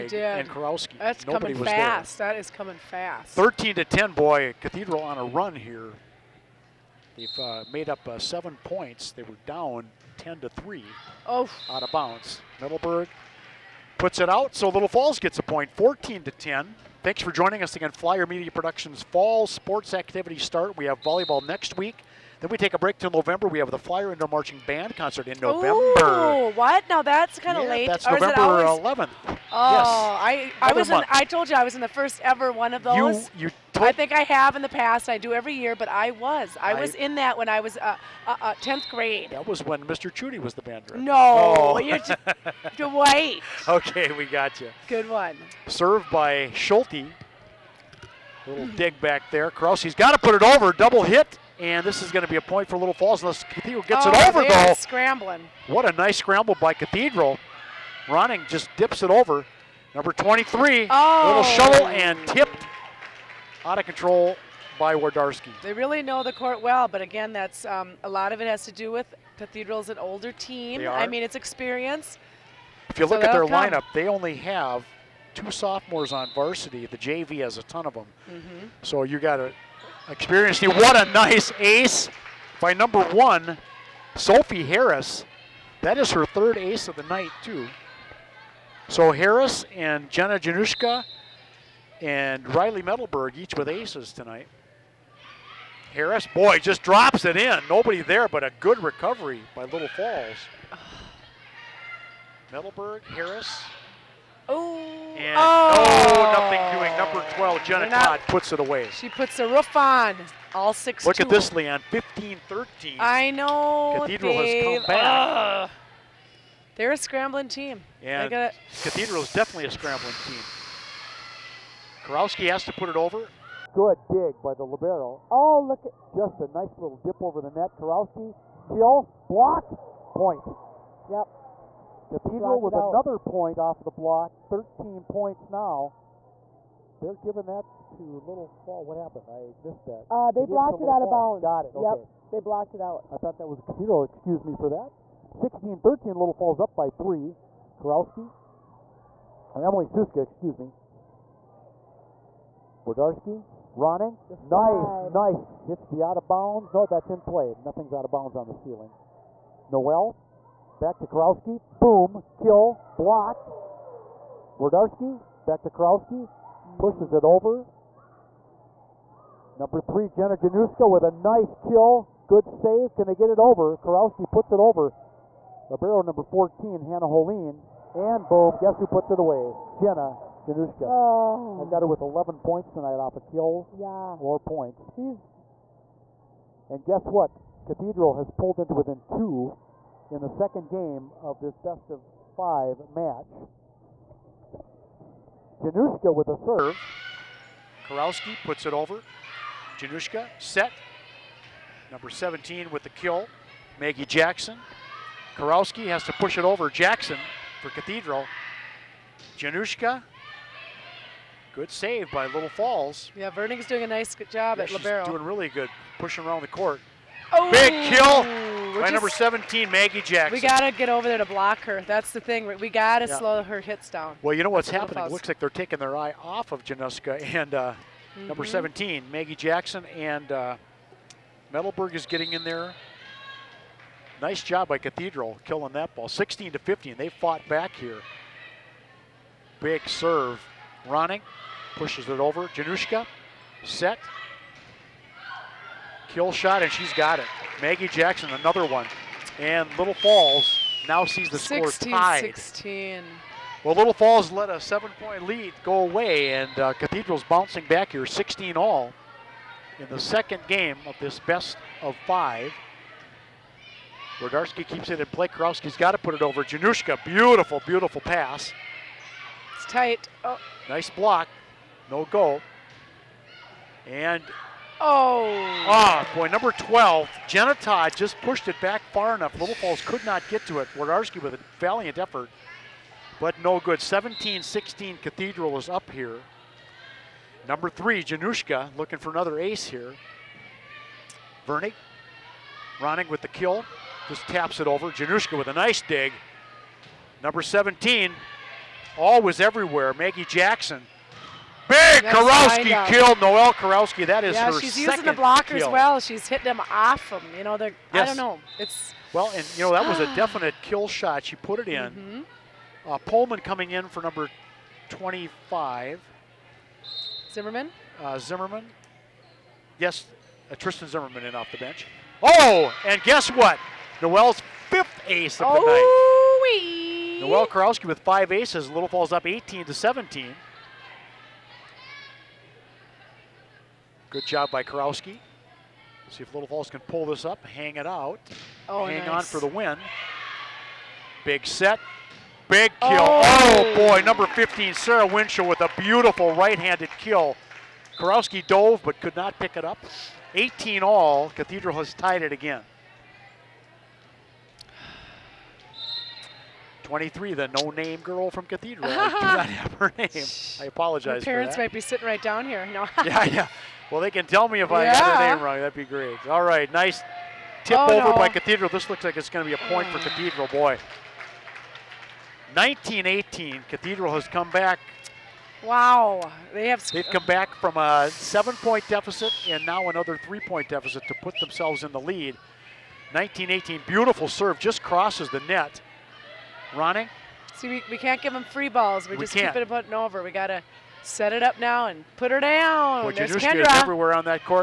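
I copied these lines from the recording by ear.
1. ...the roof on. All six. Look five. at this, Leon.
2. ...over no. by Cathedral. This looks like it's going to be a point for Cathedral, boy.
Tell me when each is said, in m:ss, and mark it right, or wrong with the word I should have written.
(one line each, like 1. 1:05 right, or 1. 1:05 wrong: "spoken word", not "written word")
1. 1:49 wrong: "two", not "five"
2. 6:07 right.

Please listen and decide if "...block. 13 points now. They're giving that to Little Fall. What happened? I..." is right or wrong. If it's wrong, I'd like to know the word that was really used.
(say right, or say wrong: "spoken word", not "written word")
right.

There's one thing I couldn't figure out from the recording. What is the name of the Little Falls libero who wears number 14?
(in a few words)
Hannah Holine.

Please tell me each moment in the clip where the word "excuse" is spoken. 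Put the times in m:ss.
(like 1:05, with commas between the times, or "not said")
2:24, 2:30.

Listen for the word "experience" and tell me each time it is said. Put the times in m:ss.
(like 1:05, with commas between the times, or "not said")
1:11, 1:20.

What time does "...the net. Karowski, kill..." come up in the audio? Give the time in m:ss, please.
2:07.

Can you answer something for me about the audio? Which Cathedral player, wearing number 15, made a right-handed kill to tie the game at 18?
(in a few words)
Sarah Winchell.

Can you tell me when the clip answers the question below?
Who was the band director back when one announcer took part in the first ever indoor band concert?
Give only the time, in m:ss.
0:39.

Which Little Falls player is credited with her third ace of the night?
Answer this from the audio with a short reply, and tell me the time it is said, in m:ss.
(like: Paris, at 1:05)
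Sophie Harris, at 1:24.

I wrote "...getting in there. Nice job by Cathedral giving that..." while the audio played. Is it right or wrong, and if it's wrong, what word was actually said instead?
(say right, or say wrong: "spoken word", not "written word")
wrong: "killing", not "giving".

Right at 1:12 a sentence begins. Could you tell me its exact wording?
If you so look at their come.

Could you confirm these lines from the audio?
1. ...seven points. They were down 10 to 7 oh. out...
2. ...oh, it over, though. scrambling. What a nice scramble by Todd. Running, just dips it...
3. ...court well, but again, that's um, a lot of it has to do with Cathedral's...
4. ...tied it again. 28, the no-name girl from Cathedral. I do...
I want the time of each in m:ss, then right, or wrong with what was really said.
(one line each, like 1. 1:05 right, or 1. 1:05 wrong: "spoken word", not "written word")
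1. 0:08 wrong: "3", not "7"
2. 0:54 wrong: "Cathedral", not "Todd"
3. 1:06 right
4. 5:51 wrong: "23", not "28".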